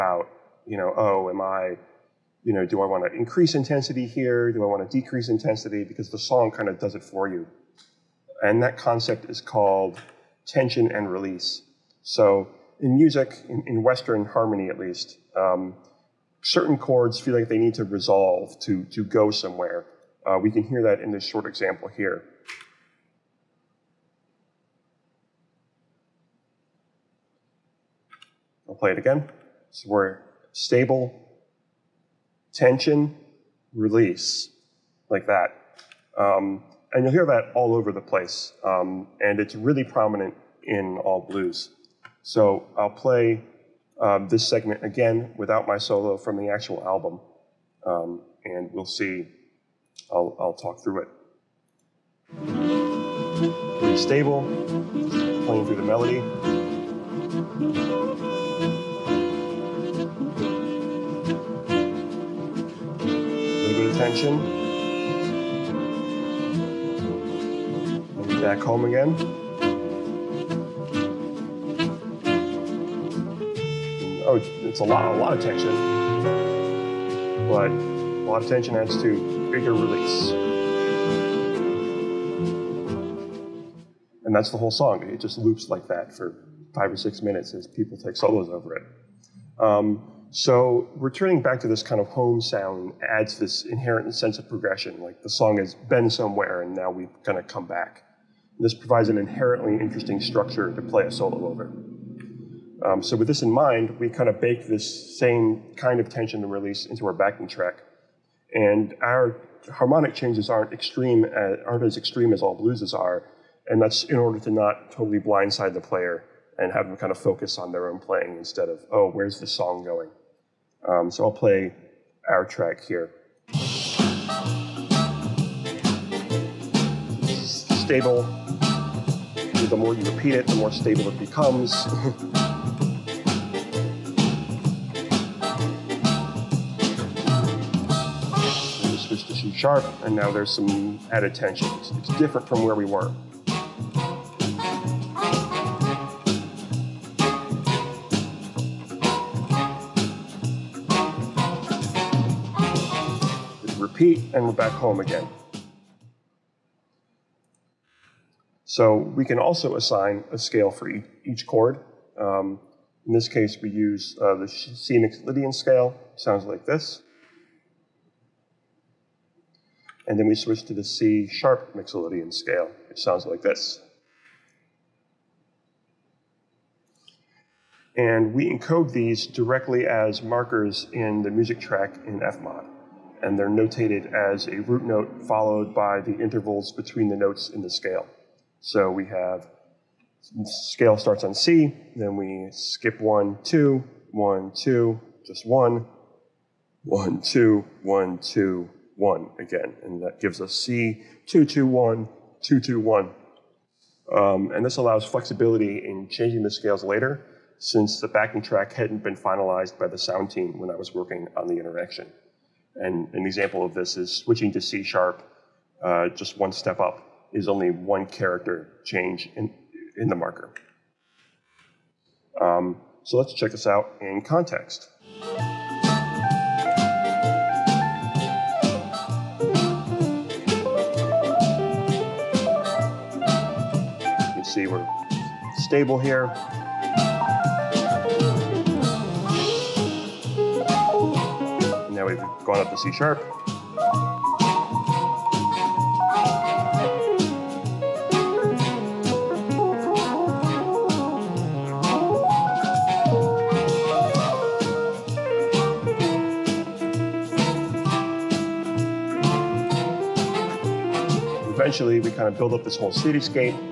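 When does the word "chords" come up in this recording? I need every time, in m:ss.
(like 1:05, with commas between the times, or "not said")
0:16, 2:41.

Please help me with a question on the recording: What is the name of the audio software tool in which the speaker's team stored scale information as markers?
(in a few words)
FMOD.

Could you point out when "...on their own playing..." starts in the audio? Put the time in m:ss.
1:57.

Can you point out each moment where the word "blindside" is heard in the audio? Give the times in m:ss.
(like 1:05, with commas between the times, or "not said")
1:55.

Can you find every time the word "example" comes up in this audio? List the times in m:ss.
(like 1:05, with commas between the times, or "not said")
0:21, 3:33.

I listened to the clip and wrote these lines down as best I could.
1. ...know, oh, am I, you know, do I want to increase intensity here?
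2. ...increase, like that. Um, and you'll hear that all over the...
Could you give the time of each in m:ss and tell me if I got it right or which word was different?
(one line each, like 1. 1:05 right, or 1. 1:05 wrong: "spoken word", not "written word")
1. 0:00 right
2. 0:33 wrong: "release", not "increase".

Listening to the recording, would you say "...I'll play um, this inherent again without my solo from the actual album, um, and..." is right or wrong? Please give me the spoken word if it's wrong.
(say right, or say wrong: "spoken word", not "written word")
wrong: "segment", not "inherent".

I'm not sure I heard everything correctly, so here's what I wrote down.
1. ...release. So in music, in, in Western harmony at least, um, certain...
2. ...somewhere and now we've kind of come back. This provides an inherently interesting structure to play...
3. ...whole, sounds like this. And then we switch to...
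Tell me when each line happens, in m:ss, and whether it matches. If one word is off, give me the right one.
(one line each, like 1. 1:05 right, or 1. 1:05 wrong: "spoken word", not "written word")
1. 0:11 right
2. 1:36 right
3. 2:45 wrong: "scale", not "whole".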